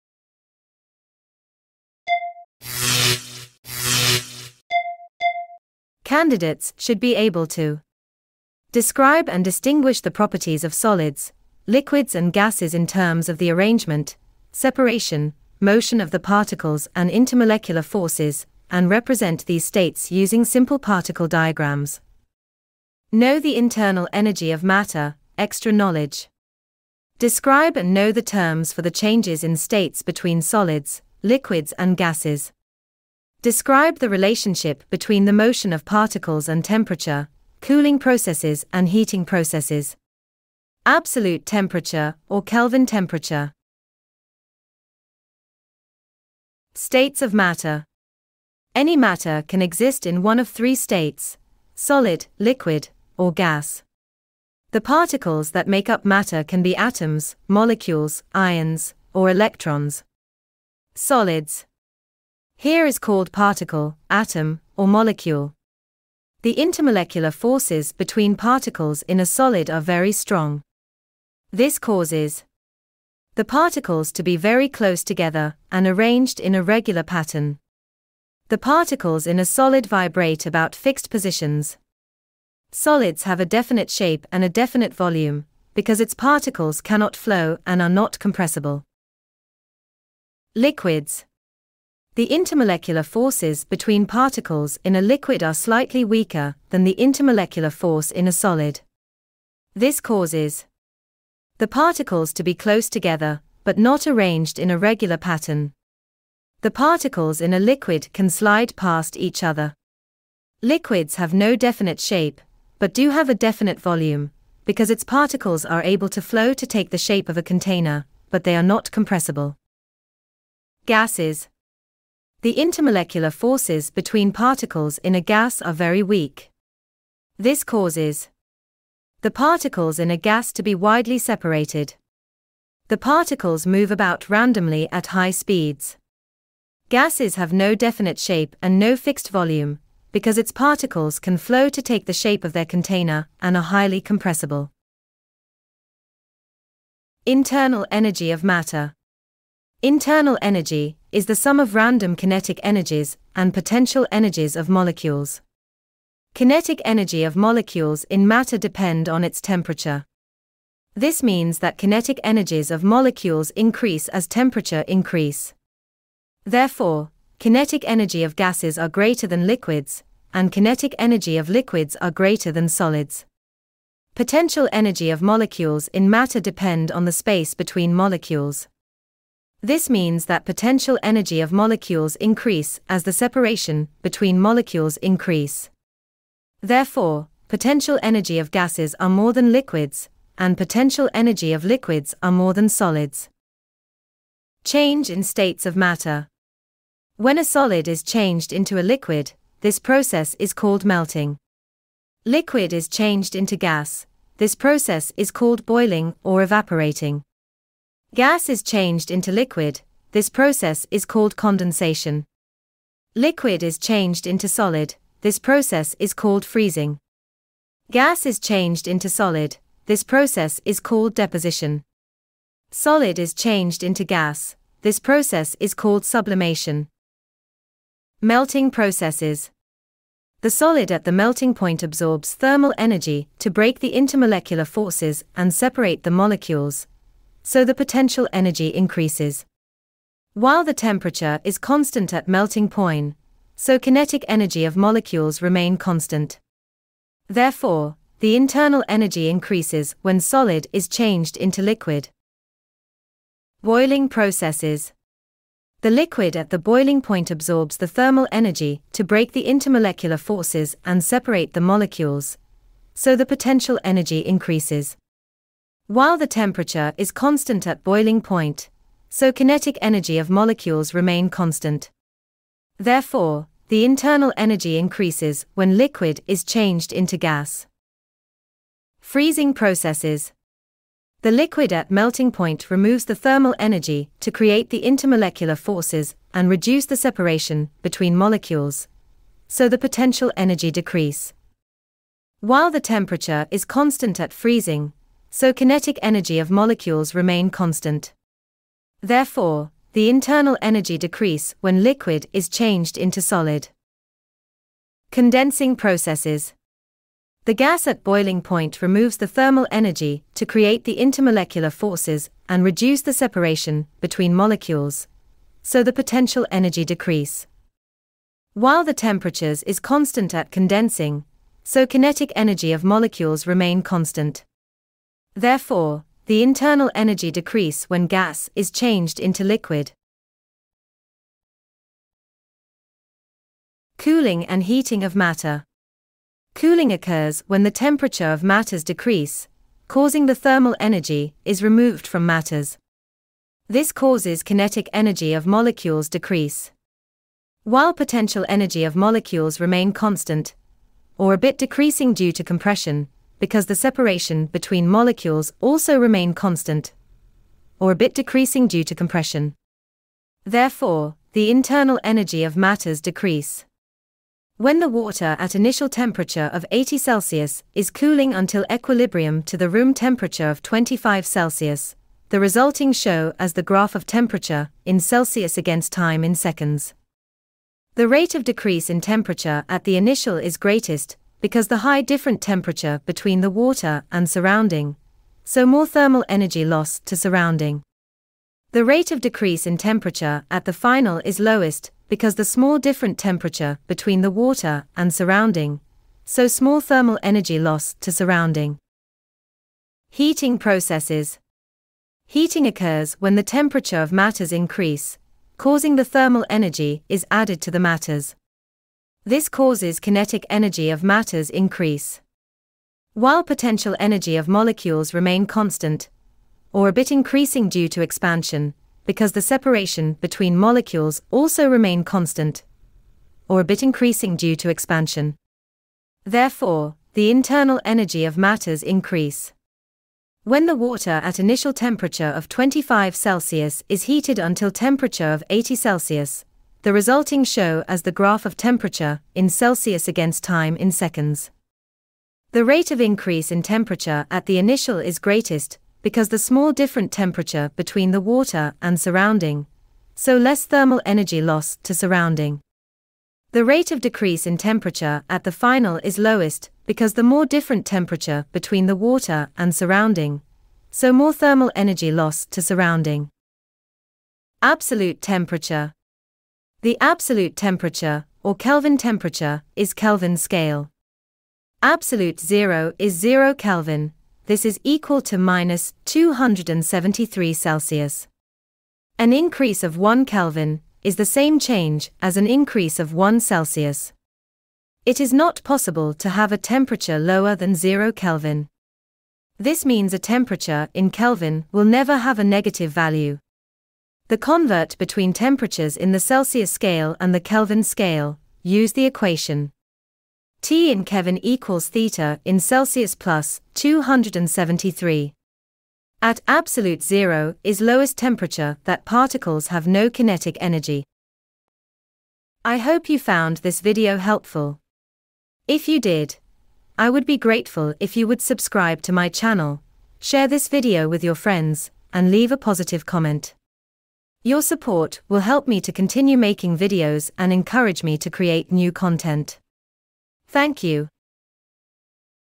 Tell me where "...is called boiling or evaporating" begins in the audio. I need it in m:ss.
3:25.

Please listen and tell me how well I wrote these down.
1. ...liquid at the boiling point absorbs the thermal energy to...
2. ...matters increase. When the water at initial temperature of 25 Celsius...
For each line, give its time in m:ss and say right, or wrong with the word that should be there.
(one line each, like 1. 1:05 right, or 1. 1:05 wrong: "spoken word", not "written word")
1. 4:15 right
2. 7:08 right.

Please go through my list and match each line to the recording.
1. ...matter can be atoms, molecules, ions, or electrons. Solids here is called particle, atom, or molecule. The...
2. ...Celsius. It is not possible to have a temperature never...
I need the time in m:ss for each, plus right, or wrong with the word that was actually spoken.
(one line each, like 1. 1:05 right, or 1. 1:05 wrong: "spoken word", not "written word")
1. 0:56 right
2. 8:03 wrong: "lower", not "never".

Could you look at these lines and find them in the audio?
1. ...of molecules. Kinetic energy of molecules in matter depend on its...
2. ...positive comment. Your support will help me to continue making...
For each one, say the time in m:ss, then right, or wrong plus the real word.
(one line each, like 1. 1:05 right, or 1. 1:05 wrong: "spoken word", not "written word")
1. 2:34 right
2. 8:42 right.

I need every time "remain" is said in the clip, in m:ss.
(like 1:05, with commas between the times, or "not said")
4:05, 4:30, 4:57, 5:23, 5:49, 5:55, 6:55, 7:01.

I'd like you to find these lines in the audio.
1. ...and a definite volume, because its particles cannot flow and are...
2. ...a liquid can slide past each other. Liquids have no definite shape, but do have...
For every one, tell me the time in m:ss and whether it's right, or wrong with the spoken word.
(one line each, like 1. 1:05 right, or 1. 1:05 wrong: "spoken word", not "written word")
1. 1:24 right
2. 1:47 right.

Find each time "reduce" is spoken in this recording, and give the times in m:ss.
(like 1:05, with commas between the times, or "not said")
4:46, 5:12.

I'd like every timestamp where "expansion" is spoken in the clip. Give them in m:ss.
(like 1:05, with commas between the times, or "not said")
6:58, 7:04.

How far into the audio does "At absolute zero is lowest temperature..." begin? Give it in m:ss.
8:26.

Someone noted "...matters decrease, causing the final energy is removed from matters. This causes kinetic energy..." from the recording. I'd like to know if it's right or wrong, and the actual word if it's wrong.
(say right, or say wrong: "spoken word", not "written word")
wrong: "thermal", not "final".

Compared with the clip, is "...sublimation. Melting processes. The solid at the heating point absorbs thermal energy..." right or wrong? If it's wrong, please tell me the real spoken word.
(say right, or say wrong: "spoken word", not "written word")
wrong: "melting", not "heating".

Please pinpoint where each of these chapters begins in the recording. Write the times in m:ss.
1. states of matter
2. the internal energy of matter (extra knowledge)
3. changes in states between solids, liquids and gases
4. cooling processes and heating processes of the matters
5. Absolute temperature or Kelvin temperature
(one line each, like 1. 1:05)
1. 0:46
2. 2:27
3. 3:14
4. 5:33
5. 7:44.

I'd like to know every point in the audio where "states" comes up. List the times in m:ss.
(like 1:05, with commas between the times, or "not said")
0:19, 0:29, 0:46, 0:50, 3:15.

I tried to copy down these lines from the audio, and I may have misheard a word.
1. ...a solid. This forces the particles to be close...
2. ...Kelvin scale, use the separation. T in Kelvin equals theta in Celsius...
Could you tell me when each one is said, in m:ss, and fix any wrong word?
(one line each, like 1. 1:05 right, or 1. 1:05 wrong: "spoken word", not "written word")
1. 1:38 wrong: "causes", not "forces"
2. 8:17 wrong: "equation", not "separation".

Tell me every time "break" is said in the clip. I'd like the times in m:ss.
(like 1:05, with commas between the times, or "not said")
3:53, 4:19.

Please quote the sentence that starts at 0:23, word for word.
Know the internal energy of matter, extra knowledge.